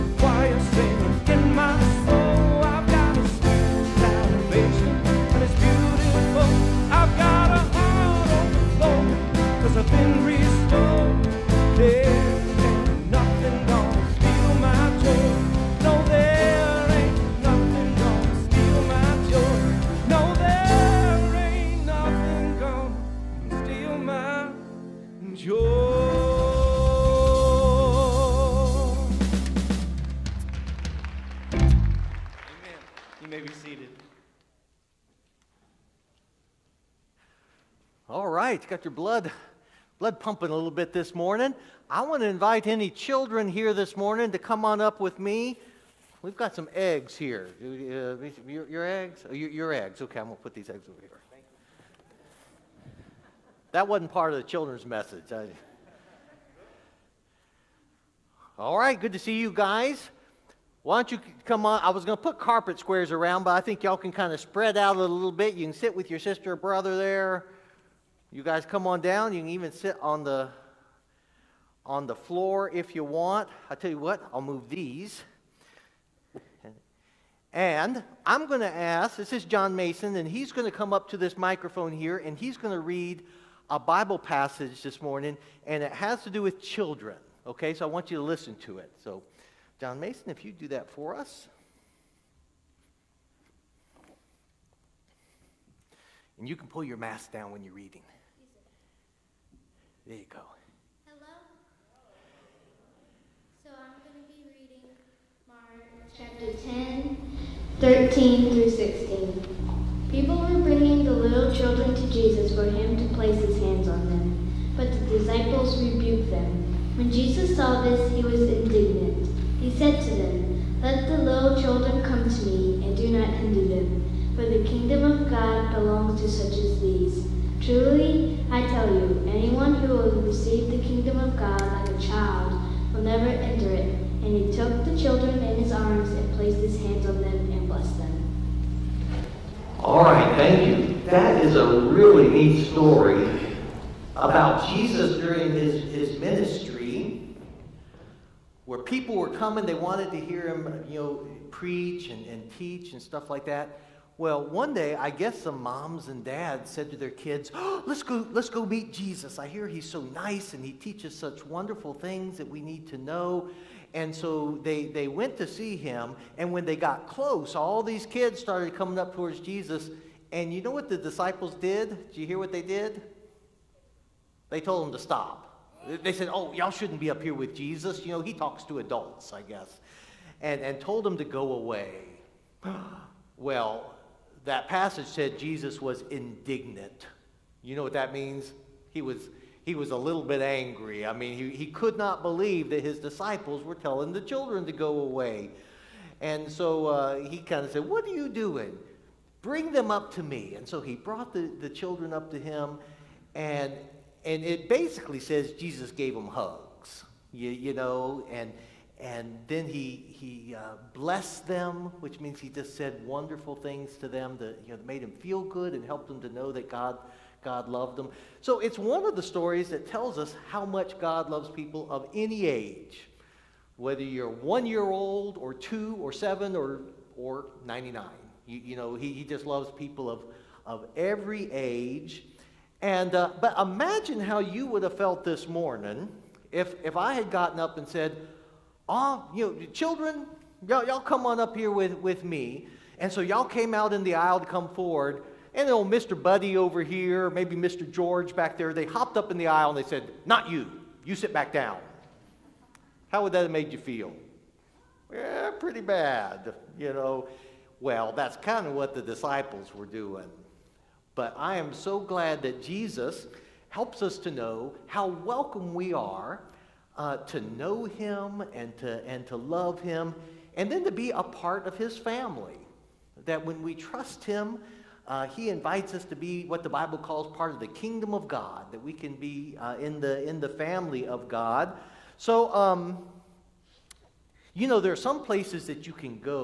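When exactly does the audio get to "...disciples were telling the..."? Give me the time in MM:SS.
03:12.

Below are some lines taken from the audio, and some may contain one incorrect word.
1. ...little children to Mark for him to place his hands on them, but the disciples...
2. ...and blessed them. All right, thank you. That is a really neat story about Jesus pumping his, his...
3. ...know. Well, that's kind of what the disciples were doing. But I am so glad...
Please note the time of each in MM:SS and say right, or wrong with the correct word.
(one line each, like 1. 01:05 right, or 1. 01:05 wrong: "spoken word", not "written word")
1. 01:51 wrong: "Jesus", not "Mark"
2. 02:17 wrong: "during", not "pumping"
3. 04:16 right.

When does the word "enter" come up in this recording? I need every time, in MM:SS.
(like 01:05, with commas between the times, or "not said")
02:13.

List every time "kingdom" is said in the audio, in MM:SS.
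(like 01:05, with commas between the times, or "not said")
02:04, 02:10, 04:37.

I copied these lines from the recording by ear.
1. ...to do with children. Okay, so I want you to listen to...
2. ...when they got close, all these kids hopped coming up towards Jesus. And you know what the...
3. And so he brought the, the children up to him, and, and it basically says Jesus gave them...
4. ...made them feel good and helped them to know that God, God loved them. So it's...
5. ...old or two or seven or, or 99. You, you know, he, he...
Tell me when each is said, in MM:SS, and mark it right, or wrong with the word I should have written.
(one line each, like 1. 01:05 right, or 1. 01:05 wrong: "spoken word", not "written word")
1. 01:26 right
2. 02:46 wrong: "started", not "hopped"
3. 03:20 right
4. 03:34 right
5. 03:44 right.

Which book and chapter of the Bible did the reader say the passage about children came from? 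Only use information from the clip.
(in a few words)
Mark chapter 10.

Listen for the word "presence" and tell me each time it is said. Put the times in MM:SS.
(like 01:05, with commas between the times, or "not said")
not said.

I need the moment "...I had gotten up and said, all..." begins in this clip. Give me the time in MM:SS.
03:56.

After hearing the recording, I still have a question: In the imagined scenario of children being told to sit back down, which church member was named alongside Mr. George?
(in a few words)
Mr. Buddy.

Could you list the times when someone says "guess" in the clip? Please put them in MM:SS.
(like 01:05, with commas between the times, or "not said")
02:35, 02:59.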